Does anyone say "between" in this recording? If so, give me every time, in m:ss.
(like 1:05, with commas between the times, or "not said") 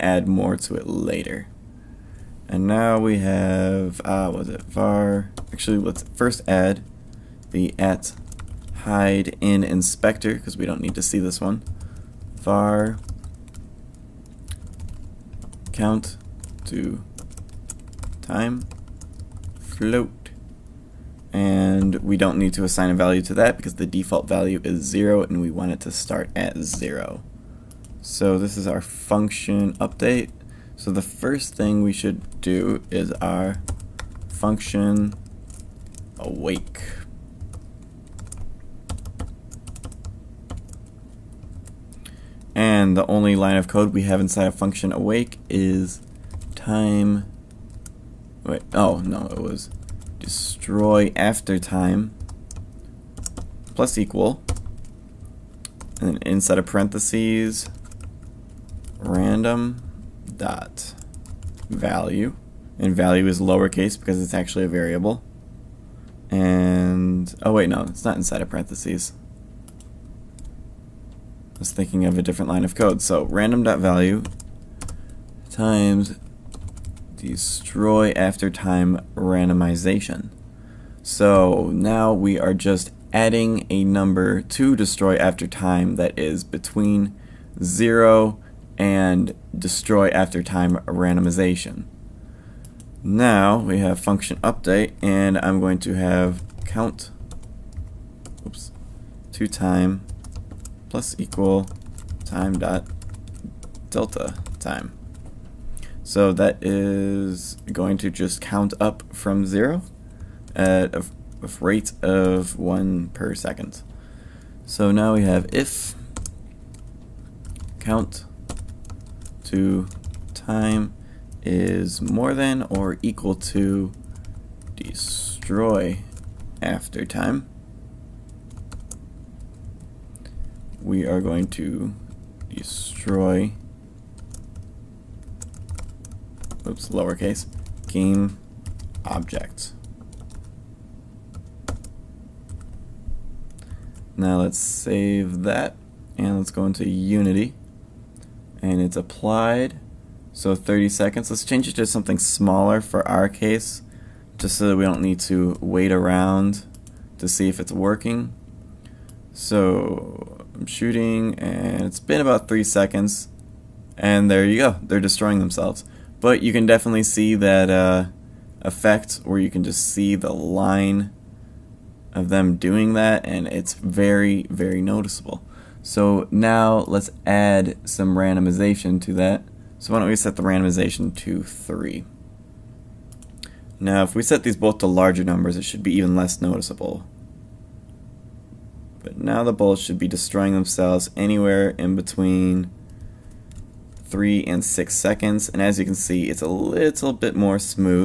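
1:26, 3:11.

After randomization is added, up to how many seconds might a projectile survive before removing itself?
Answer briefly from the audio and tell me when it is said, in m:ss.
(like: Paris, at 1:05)
6, at 3:14.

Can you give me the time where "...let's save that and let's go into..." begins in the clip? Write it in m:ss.
2:24.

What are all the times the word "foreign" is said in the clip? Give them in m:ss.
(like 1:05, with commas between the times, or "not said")
not said.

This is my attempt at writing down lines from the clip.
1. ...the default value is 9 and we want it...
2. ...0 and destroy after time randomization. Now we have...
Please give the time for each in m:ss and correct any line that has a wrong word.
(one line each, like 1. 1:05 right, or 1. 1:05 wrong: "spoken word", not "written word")
1. 0:23 wrong: "0", not "9"
2. 1:27 right.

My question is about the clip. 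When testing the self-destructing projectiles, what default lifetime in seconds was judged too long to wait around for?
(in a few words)
30.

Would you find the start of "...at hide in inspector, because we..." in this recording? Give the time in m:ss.
0:07.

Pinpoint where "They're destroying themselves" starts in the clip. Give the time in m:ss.
2:44.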